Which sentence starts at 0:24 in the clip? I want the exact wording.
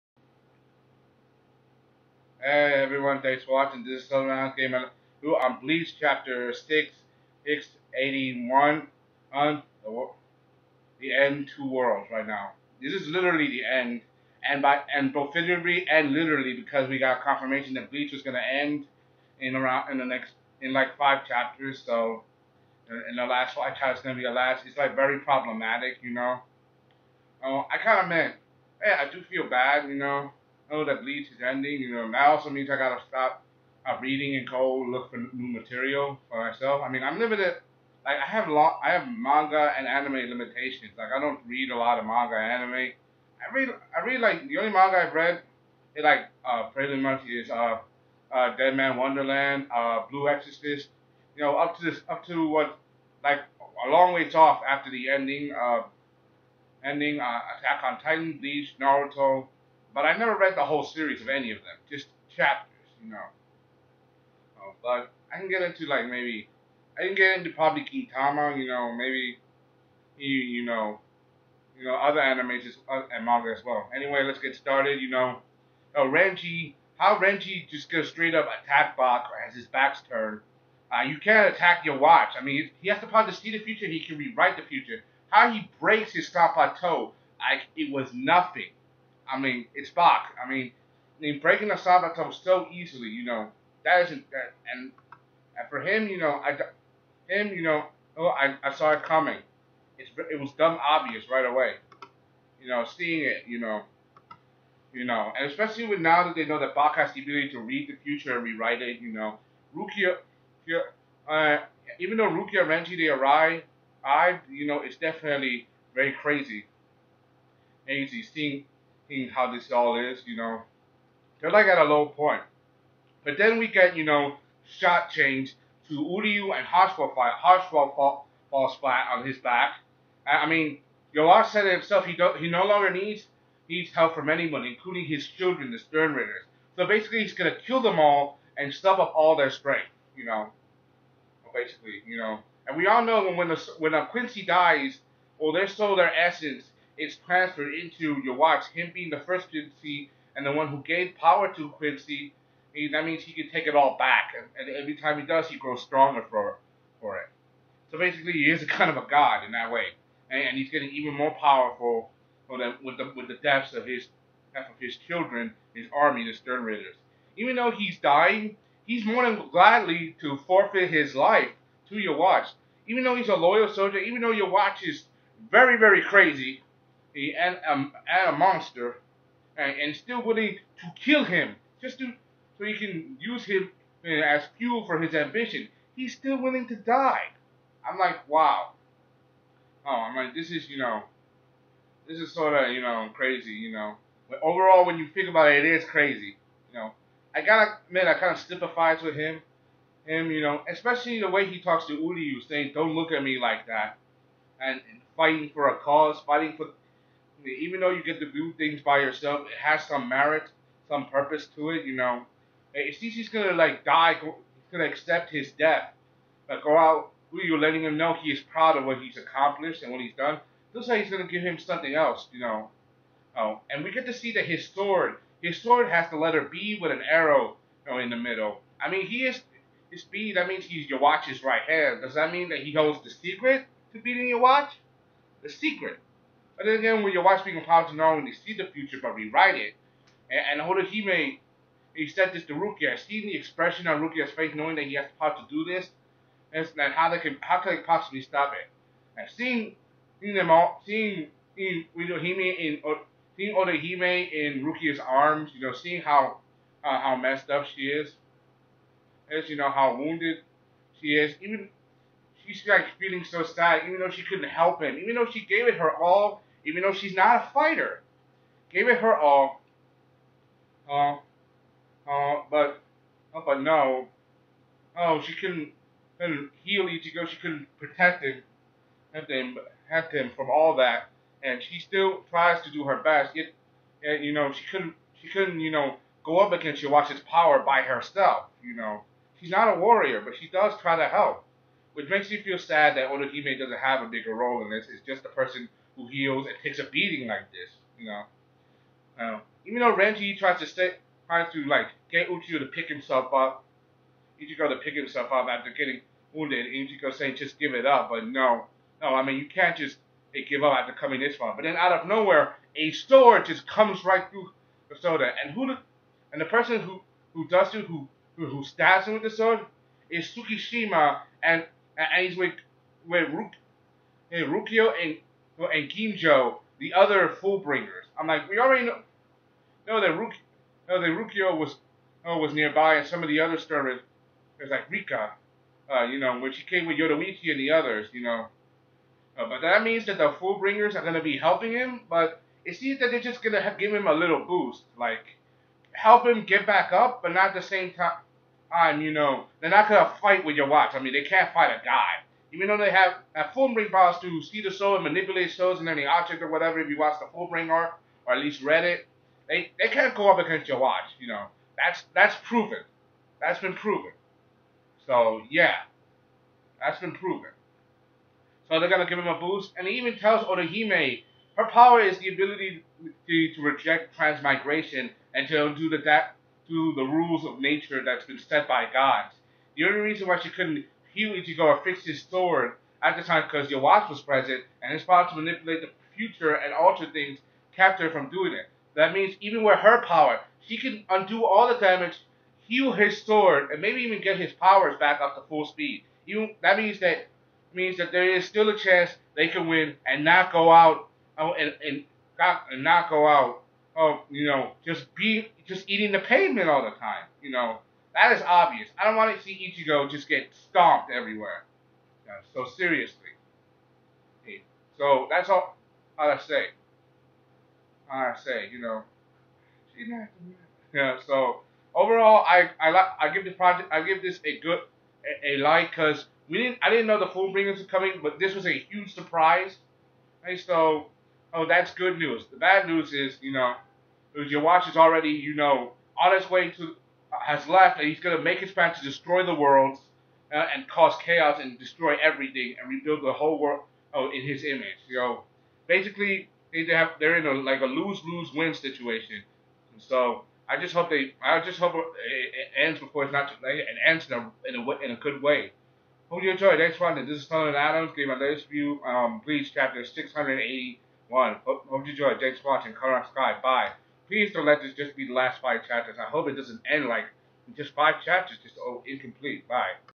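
It's like very problematic, you know.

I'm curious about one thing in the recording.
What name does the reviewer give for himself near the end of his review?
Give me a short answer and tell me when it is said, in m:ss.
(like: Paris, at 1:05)
Tony Adams, at 7:37.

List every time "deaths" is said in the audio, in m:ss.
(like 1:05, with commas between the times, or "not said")
2:43, 3:35.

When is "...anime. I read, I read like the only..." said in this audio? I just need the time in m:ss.
0:42.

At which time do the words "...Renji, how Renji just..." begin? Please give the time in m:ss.
1:16.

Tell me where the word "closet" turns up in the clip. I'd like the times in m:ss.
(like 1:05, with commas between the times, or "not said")
not said.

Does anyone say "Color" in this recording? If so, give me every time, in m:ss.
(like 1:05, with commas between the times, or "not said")
7:42.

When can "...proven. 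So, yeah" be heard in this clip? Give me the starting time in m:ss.
6:03.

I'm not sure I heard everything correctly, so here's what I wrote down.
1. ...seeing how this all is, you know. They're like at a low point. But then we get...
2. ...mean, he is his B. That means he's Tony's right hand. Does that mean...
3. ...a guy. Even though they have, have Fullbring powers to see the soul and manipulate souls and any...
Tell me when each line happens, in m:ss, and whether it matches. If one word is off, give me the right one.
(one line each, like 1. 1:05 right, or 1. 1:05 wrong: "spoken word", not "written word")
1. 1:58 right
2. 3:48 wrong: "Yhwach", not "Tony"
3. 5:51 right.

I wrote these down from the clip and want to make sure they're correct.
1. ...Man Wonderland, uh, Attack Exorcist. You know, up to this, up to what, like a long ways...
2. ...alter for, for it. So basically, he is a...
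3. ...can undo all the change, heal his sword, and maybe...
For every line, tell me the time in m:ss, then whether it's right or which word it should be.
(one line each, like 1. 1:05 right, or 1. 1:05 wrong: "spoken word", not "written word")
1. 0:48 wrong: "Blue", not "Attack"
2. 2:35 wrong: "stronger", not "alter"
3. 6:30 wrong: "damage", not "change".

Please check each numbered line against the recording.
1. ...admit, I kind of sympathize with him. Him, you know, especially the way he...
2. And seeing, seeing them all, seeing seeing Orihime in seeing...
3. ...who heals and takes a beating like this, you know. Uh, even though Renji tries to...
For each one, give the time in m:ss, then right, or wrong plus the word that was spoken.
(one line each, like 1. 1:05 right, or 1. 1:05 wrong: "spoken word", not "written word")
1. 3:17 right
2. 4:09 right
3. 4:55 right.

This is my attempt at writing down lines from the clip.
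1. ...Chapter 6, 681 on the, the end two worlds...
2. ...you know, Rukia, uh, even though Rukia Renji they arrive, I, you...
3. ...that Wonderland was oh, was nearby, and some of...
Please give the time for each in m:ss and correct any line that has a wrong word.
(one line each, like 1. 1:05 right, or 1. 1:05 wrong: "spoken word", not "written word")
1. 0:05 right
2. 1:48 right
3. 5:31 wrong: "Rukio", not "Wonderland".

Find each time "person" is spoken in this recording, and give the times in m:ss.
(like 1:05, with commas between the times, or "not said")
4:55, 5:16.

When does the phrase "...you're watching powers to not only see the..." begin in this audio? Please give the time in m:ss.
3:57.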